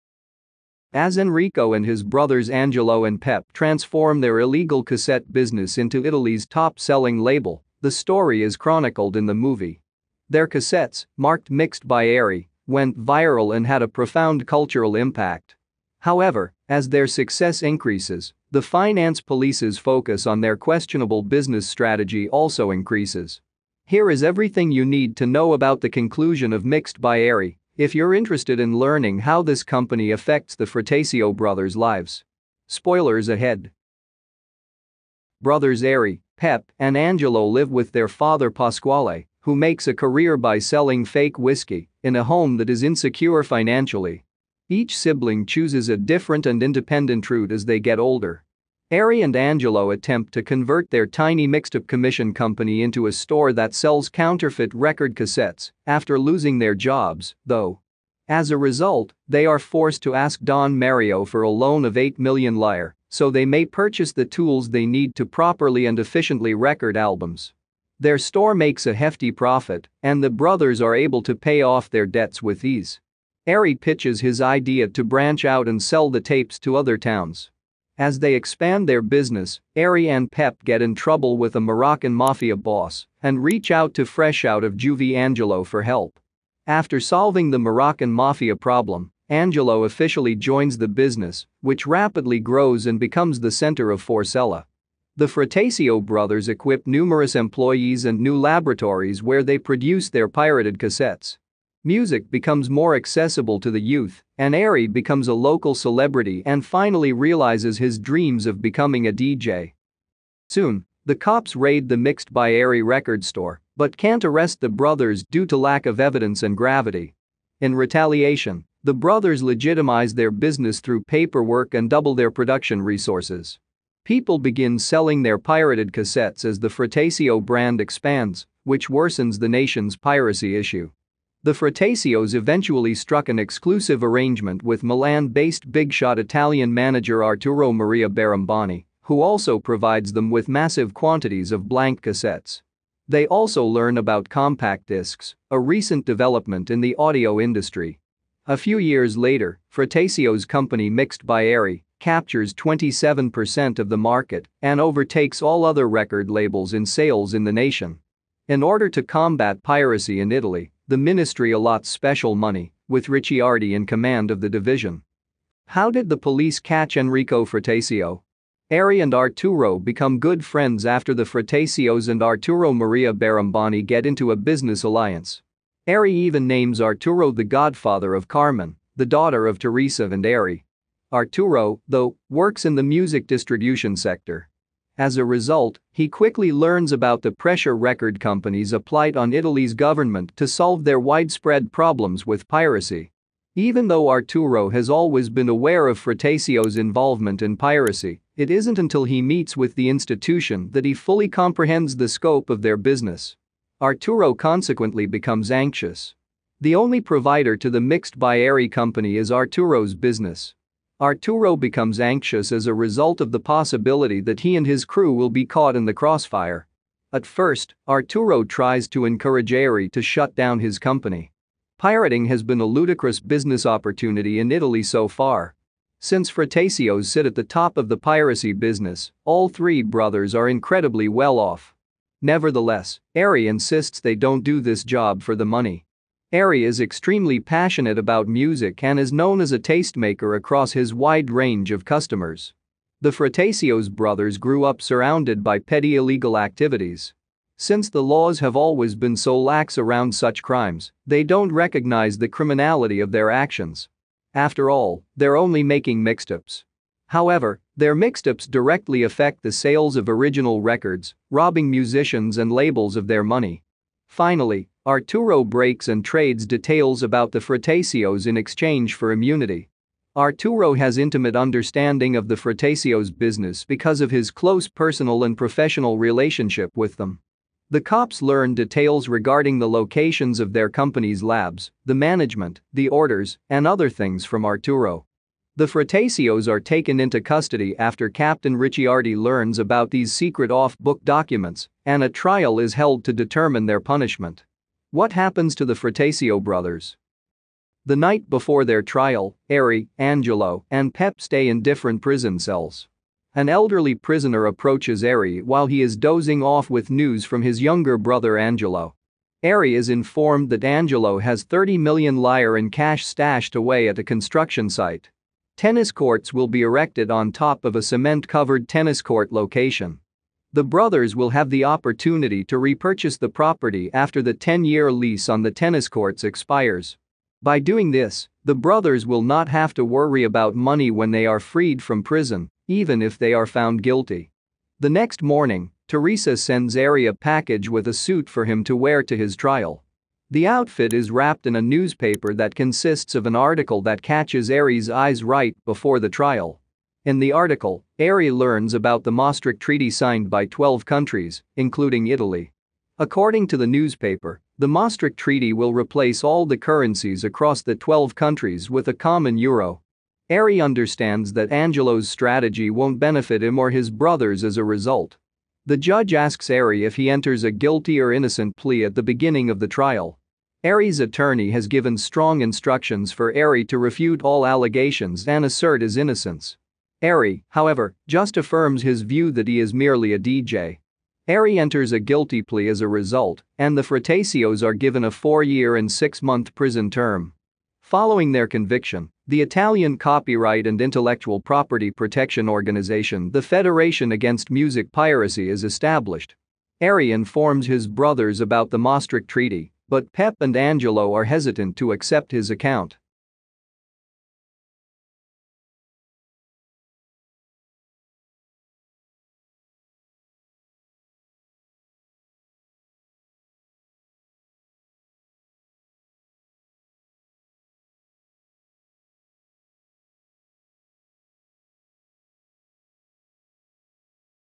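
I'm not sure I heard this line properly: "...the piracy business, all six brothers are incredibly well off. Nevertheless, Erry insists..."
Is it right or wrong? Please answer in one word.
wrong.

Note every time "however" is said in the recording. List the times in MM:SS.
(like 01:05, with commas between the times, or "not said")
00:16, 04:17, 06:17.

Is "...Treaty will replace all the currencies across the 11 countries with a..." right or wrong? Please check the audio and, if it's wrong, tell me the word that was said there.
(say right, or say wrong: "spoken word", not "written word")
wrong: "12", not "11".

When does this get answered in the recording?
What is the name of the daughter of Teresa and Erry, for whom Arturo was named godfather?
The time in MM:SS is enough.
02:58.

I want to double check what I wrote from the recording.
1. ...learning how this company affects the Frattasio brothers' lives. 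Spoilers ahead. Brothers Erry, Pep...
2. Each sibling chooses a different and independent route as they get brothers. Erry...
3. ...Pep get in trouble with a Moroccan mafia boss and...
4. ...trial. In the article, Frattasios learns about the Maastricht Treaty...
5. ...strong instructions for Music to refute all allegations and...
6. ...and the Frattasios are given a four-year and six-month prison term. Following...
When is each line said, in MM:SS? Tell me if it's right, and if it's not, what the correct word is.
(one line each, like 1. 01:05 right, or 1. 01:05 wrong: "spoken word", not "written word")
1. 00:28 right
2. 00:44 wrong: "older", not "brothers"
3. 01:20 right
4. 05:46 wrong: "Erry", not "Frattasios"
5. 06:11 wrong: "Erry", not "Music"
6. 06:23 right.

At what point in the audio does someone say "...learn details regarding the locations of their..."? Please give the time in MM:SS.
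04:38.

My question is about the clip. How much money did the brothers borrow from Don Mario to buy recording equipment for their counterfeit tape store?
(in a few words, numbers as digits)
8 million lire.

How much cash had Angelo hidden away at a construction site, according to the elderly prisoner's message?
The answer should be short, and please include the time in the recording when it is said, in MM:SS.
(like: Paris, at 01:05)
30 million lire, at 05:11.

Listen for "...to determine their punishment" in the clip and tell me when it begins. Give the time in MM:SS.
04:53.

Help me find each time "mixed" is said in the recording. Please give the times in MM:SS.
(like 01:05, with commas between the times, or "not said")
00:11, 00:26, 00:51, 01:51, 02:30, 03:27.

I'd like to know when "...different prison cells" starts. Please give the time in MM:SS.
05:01.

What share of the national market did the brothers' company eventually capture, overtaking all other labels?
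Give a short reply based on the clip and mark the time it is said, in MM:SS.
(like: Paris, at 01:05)
27%, at 02:32.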